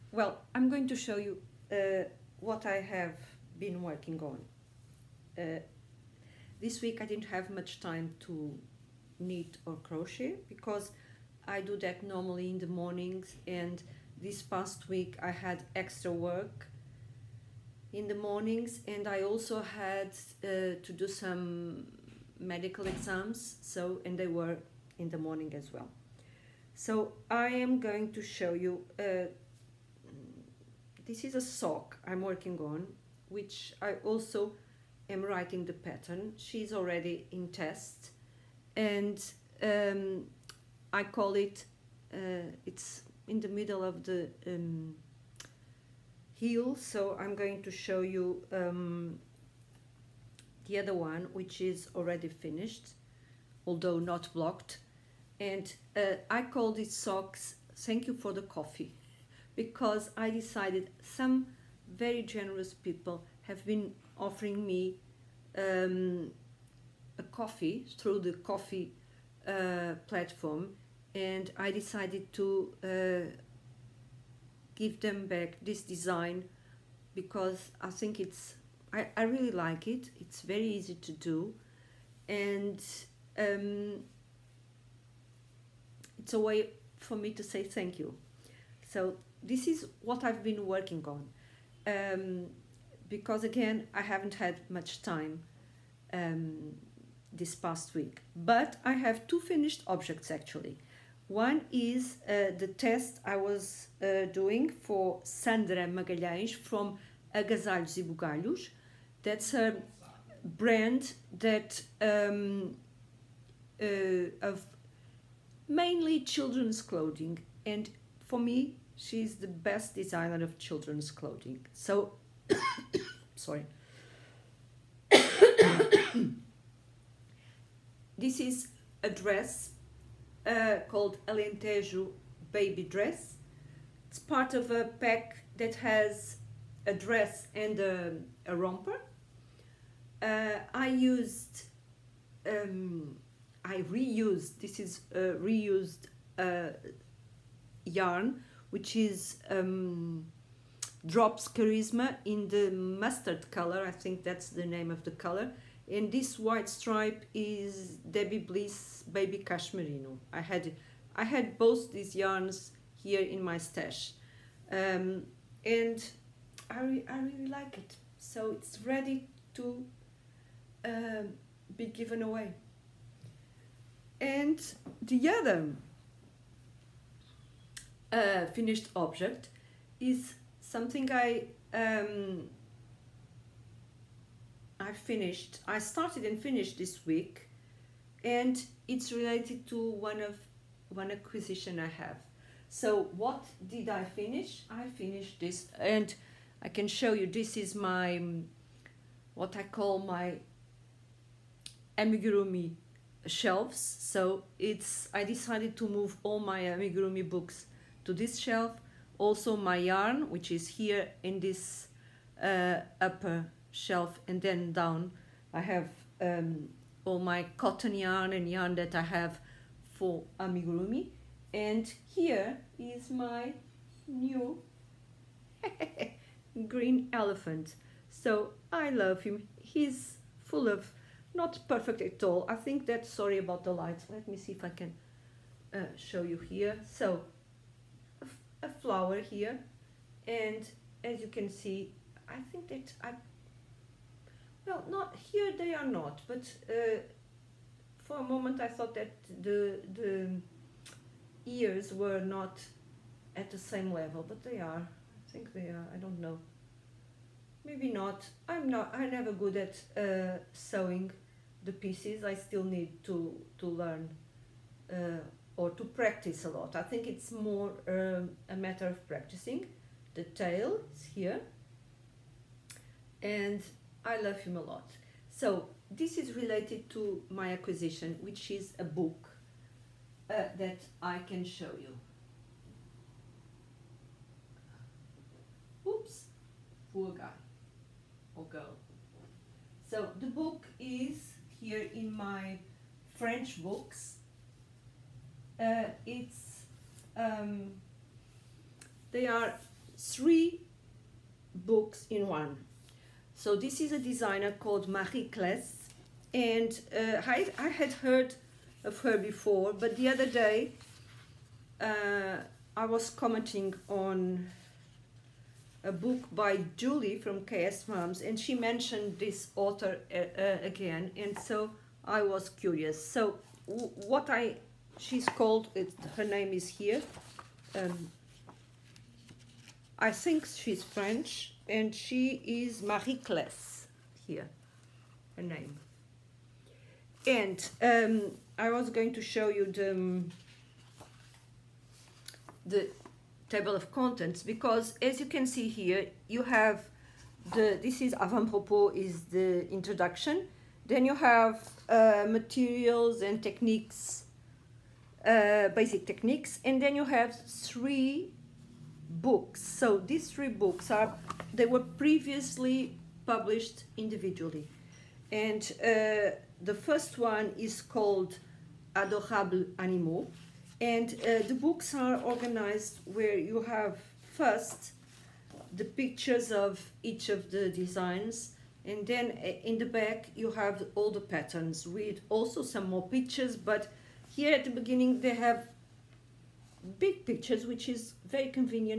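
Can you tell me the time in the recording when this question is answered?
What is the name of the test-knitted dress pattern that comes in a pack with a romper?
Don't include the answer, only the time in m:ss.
2:11.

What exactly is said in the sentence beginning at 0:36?
She's already in test and um, I call it, uh, it's in the middle of the um, heel.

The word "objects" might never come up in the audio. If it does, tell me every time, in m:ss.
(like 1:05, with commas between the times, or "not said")
1:39, 2:58.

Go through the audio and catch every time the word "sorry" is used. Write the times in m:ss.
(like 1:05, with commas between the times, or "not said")
2:03, 3:53.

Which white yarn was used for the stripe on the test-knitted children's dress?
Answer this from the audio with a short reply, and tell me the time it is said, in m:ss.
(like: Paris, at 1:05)
Debby Bliss Baby Cashmerino, at 2:38.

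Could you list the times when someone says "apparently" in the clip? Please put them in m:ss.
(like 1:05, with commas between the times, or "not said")
not said.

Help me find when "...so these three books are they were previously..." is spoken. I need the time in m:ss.
5:59.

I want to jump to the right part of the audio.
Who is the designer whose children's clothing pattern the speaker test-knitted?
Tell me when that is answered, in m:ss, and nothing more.
1:45.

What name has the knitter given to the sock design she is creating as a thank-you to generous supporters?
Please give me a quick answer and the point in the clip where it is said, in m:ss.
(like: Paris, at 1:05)
Thank you for the coffee, at 0:57.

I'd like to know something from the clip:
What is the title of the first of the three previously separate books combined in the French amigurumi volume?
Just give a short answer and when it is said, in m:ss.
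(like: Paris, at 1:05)
Adorable animaux, at 6:08.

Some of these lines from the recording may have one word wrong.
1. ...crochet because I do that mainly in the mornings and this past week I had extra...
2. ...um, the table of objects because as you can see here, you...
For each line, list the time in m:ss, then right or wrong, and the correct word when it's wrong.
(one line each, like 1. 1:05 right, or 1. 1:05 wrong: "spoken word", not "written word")
1. 0:09 wrong: "normally", not "mainly"
2. 5:39 wrong: "contents", not "objects".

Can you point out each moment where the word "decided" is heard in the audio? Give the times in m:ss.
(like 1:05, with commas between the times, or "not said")
1:00, 1:11, 3:25.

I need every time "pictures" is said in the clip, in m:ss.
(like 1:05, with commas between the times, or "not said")
6:15, 6:23, 6:27.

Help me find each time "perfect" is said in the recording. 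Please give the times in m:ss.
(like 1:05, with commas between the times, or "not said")
3:51.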